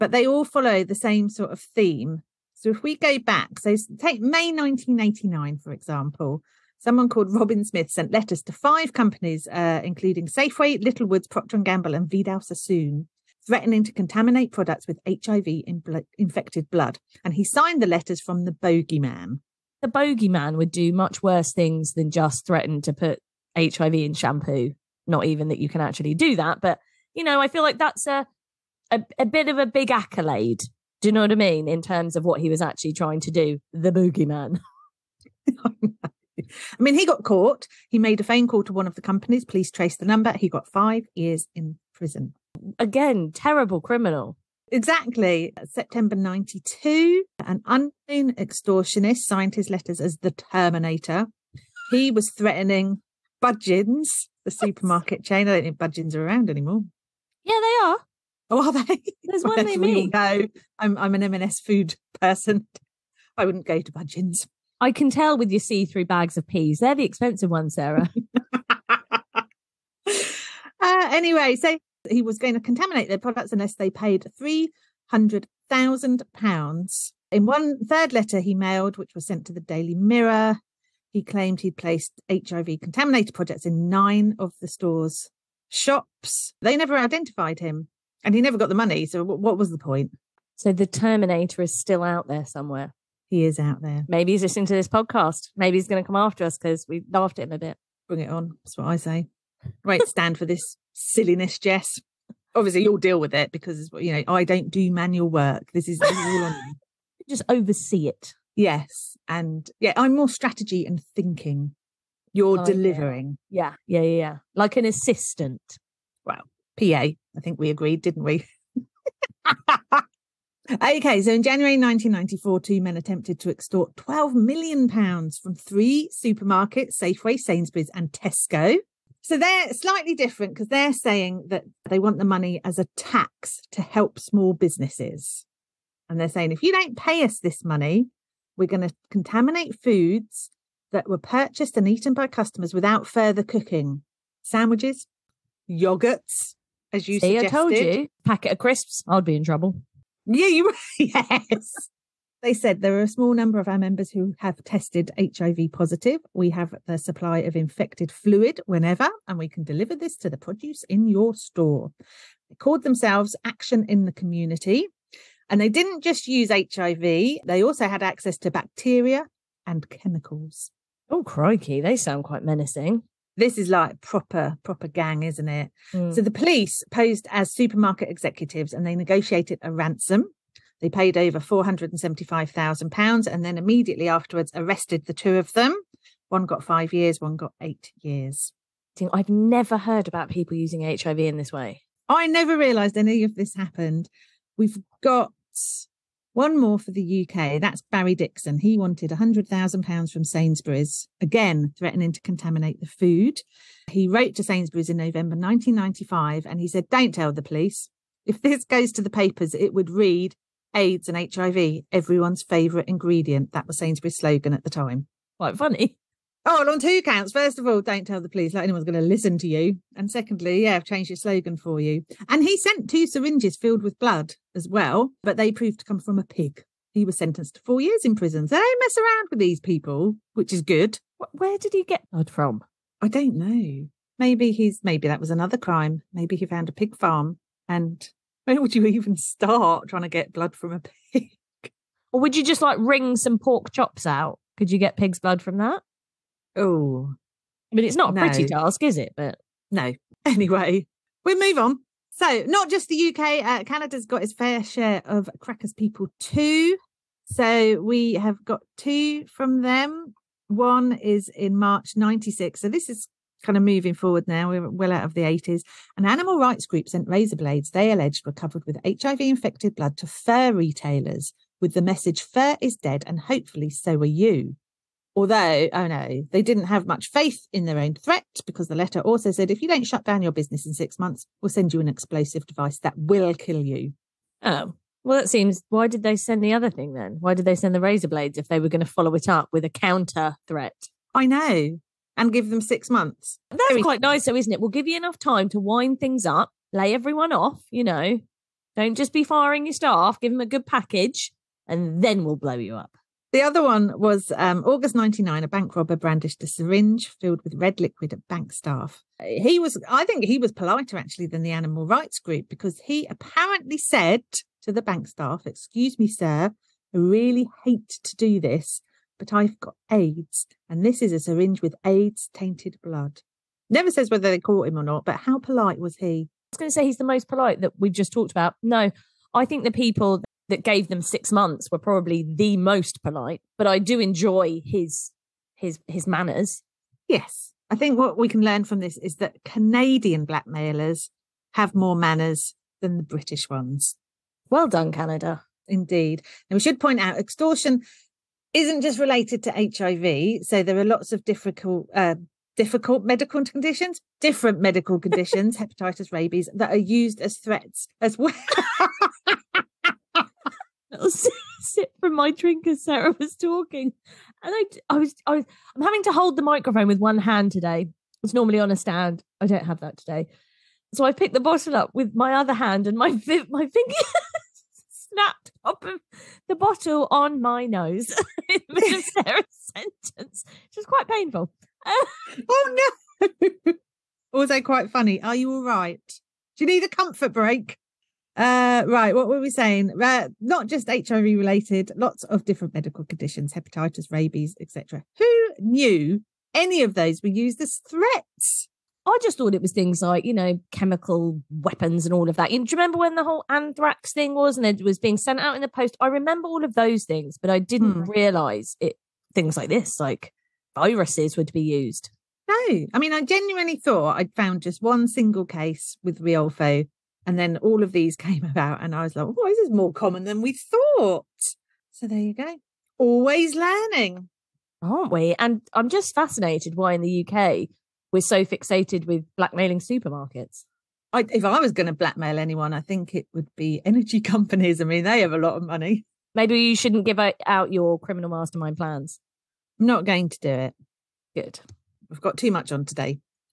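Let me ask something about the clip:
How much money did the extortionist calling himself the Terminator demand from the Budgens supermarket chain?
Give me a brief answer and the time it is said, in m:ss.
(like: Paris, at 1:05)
£300,000, at 1:14.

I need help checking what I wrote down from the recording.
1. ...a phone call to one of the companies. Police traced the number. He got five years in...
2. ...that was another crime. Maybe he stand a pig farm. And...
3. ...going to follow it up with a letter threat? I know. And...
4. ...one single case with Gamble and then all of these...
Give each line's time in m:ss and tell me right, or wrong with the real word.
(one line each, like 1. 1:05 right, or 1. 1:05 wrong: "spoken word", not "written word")
1. 0:38 right
2. 3:55 wrong: "found", not "stand"
3. 4:48 wrong: "counter", not "letter"
4. 6:54 wrong: "Riolfo", not "Gamble".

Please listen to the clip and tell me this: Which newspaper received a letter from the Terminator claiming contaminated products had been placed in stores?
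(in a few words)
Daily Mirror.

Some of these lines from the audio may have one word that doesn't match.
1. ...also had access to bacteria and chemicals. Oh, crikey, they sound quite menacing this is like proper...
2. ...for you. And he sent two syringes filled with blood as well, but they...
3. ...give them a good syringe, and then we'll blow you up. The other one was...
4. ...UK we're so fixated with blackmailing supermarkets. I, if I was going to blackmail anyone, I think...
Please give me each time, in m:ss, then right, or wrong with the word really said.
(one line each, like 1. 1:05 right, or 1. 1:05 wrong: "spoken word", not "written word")
1. 2:47 right
2. 3:41 right
3. 5:00 wrong: "package", not "syringe"
4. 7:07 right.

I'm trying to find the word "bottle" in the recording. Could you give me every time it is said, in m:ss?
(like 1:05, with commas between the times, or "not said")
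6:11, 6:16.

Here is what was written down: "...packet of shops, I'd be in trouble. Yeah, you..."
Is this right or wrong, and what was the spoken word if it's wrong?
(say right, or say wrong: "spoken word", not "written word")
wrong: "crisps", not "shops".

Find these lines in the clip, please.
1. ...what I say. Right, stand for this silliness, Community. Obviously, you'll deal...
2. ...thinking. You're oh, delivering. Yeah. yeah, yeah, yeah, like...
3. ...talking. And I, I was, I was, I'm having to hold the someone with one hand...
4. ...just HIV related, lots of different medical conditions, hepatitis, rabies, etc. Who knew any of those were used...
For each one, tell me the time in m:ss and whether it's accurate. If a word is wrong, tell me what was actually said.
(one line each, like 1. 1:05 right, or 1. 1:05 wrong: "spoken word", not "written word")
1. 1:38 wrong: "Jess", not "Community"
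2. 1:51 right
3. 6:03 wrong: "microphone", not "someone"
4. 6:30 right.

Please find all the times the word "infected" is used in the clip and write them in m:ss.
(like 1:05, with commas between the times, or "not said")
0:15, 2:37, 4:29.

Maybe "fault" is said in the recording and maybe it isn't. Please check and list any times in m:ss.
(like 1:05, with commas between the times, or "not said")
not said.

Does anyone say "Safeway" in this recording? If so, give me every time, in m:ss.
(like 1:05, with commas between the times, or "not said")
0:10, 2:06.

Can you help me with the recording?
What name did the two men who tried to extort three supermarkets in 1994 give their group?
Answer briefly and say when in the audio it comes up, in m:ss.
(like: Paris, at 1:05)
Action in the Community, at 2:43.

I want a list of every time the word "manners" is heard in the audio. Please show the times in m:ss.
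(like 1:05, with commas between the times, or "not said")
5:36, 5:41.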